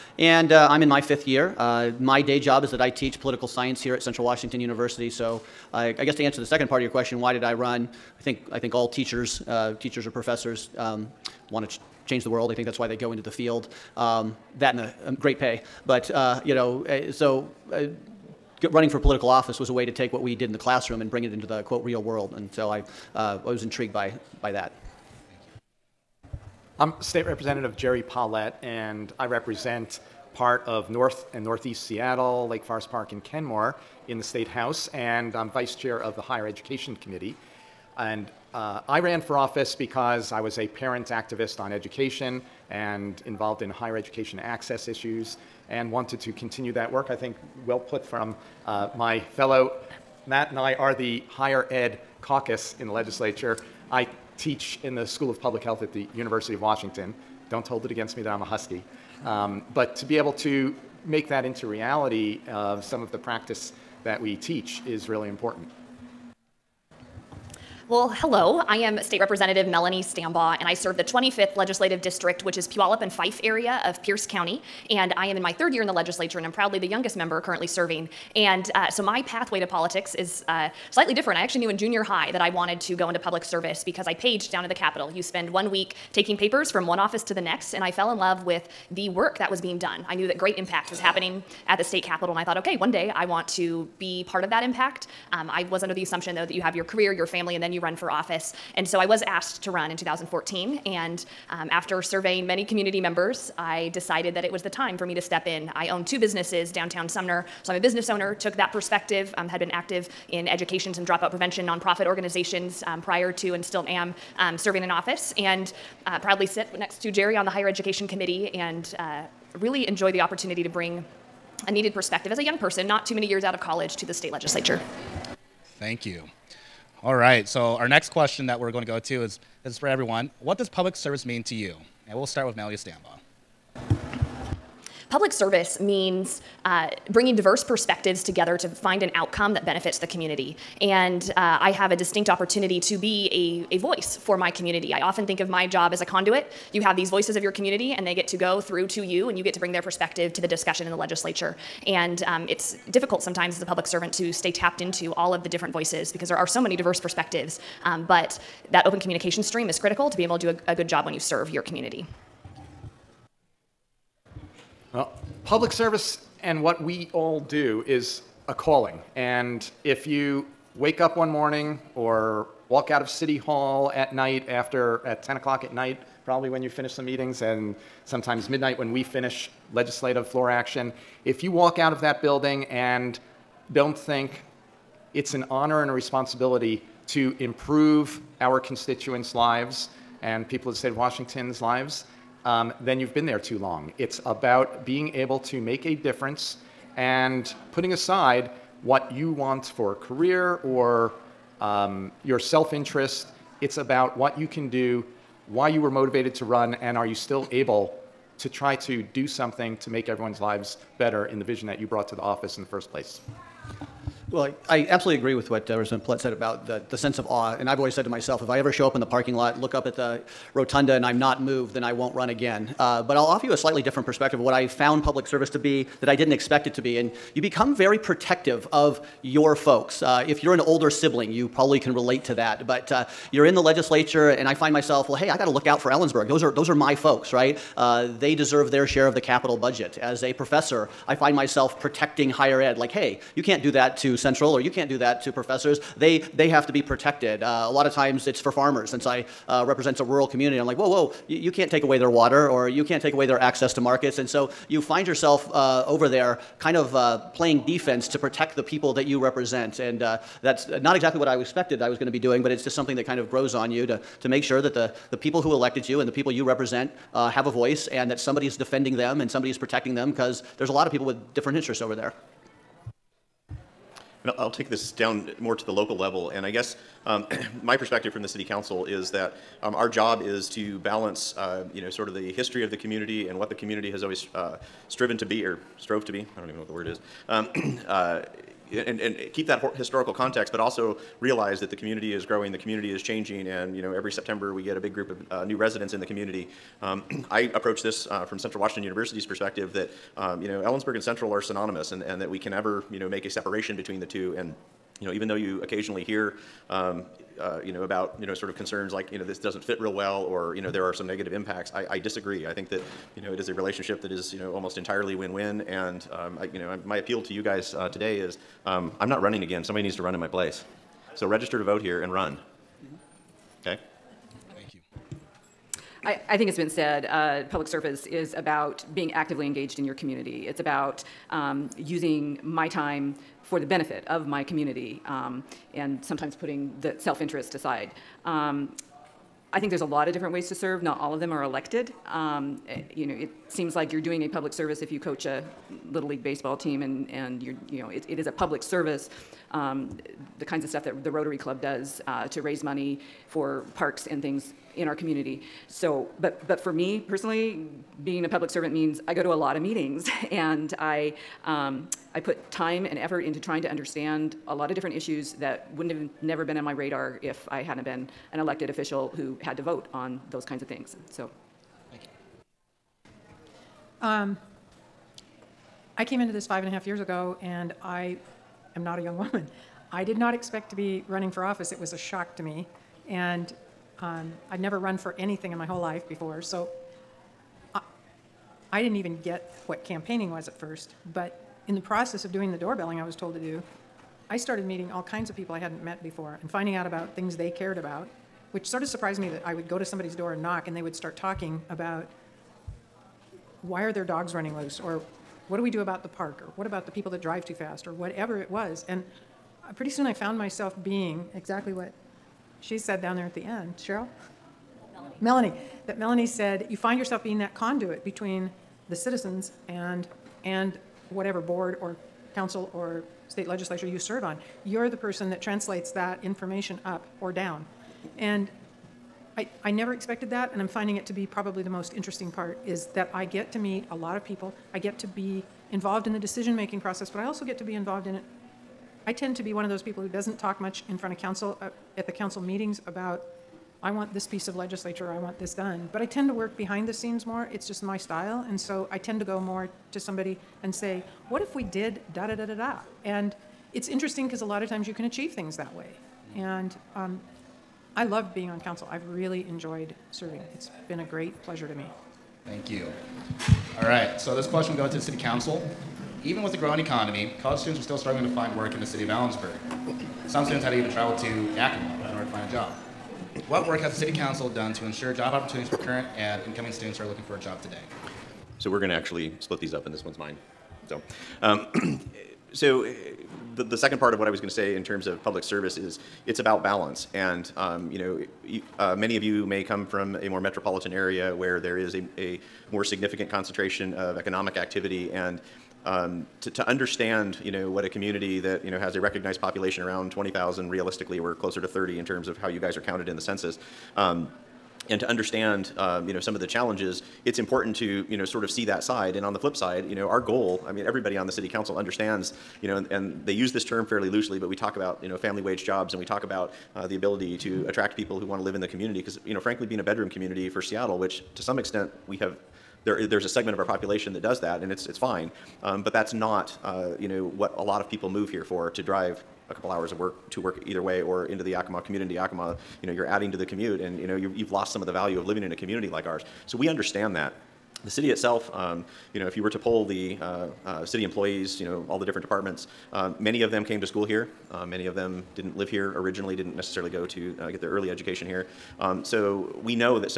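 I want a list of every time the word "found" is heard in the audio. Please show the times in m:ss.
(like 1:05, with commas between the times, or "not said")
3:44, 6:50.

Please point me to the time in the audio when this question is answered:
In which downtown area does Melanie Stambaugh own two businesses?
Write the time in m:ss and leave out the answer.
1:47.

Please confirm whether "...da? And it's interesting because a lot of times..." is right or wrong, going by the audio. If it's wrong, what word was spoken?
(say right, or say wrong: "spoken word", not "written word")
right.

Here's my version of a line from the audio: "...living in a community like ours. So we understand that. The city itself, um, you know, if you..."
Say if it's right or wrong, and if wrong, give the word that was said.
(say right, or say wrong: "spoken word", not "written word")
right.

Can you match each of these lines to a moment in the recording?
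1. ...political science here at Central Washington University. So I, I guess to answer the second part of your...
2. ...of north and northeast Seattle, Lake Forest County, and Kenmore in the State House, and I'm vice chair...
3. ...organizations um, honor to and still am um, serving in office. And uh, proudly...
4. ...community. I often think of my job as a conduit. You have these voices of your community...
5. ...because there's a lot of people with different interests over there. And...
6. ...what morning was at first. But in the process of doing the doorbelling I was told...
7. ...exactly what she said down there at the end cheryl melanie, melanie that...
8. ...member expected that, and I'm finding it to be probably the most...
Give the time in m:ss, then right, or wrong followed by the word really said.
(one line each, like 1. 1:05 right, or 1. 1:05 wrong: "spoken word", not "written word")
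1. 0:03 right
2. 0:30 wrong: "Park", not "County"
3. 1:52 wrong: "prior", not "honor"
4. 2:24 right
5. 4:30 right
6. 6:29 wrong: "campaigning", not "morning"
7. 6:51 right
8. 7:09 wrong: "never", not "member".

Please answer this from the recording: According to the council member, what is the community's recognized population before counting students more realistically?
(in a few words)
20,000.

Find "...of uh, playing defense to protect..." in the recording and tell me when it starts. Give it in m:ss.
4:16.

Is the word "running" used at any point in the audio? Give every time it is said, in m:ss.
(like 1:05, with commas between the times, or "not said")
0:18, 5:19, 6:21, 6:44.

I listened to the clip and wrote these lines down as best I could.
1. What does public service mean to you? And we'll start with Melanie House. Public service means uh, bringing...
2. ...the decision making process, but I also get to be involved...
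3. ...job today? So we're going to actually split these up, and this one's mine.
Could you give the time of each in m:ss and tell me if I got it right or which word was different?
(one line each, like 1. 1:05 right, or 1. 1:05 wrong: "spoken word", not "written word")
1. 2:10 wrong: "Stambaugh", not "House"
2. 7:16 right
3. 7:57 right.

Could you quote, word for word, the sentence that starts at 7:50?
Some students had to even travel to Yakima in order to find a job.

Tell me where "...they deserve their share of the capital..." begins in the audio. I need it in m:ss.
3:58.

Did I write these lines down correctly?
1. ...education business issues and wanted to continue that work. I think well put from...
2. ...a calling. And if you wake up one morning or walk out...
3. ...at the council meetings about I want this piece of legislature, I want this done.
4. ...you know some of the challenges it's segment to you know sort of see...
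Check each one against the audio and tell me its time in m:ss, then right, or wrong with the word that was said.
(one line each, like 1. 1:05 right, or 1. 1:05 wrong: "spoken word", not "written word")
1. 0:43 wrong: "access", not "business"
2. 2:48 right
3. 7:21 right
4. 8:26 wrong: "important", not "segment".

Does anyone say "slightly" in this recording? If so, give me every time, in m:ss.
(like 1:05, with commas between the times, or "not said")
1:20, 3:43.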